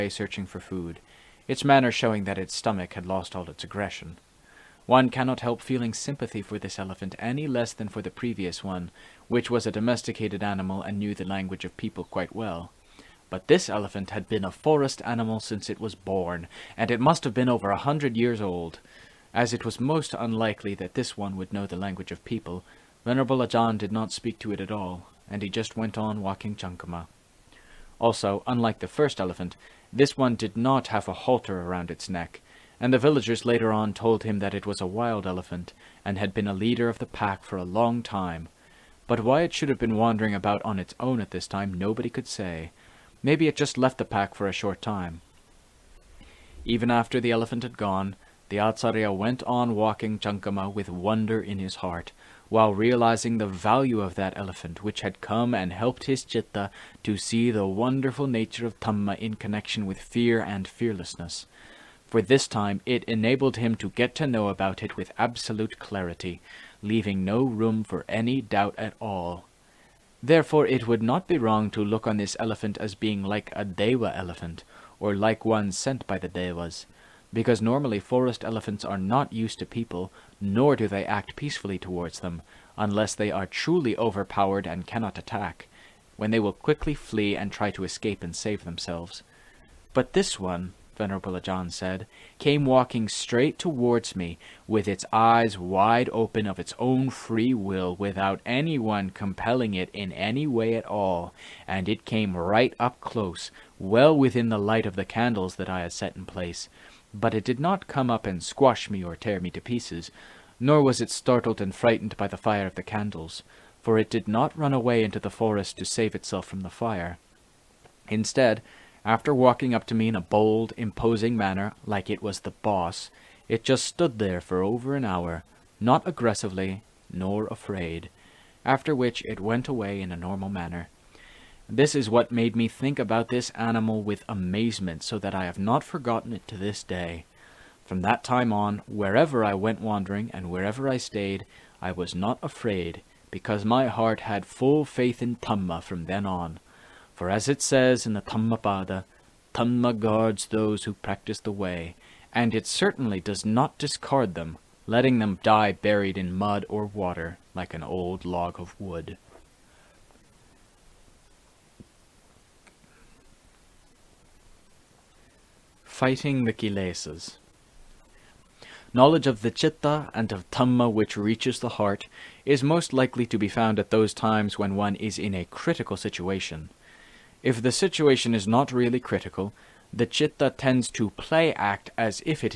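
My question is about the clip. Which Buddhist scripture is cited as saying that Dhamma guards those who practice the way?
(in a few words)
Dhammapada.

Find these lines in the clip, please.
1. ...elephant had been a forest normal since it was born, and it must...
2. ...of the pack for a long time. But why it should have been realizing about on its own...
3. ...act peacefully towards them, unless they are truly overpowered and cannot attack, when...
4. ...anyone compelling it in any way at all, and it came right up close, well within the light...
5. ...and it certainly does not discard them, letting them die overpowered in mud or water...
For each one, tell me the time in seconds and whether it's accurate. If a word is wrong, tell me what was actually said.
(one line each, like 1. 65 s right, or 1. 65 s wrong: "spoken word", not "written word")
1. 13 s wrong: "animal", not "normal"
2. 36 s wrong: "wandering", not "realizing"
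3. 81 s right
4. 98 s right
5. 152 s wrong: "buried", not "overpowered".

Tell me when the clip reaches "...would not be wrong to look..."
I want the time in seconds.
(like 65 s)
70 s.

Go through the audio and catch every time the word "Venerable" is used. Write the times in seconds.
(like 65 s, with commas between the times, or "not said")
23 s, 90 s.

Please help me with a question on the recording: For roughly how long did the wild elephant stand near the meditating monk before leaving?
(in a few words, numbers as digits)
over an hour.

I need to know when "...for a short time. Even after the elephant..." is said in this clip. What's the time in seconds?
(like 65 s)
44 s.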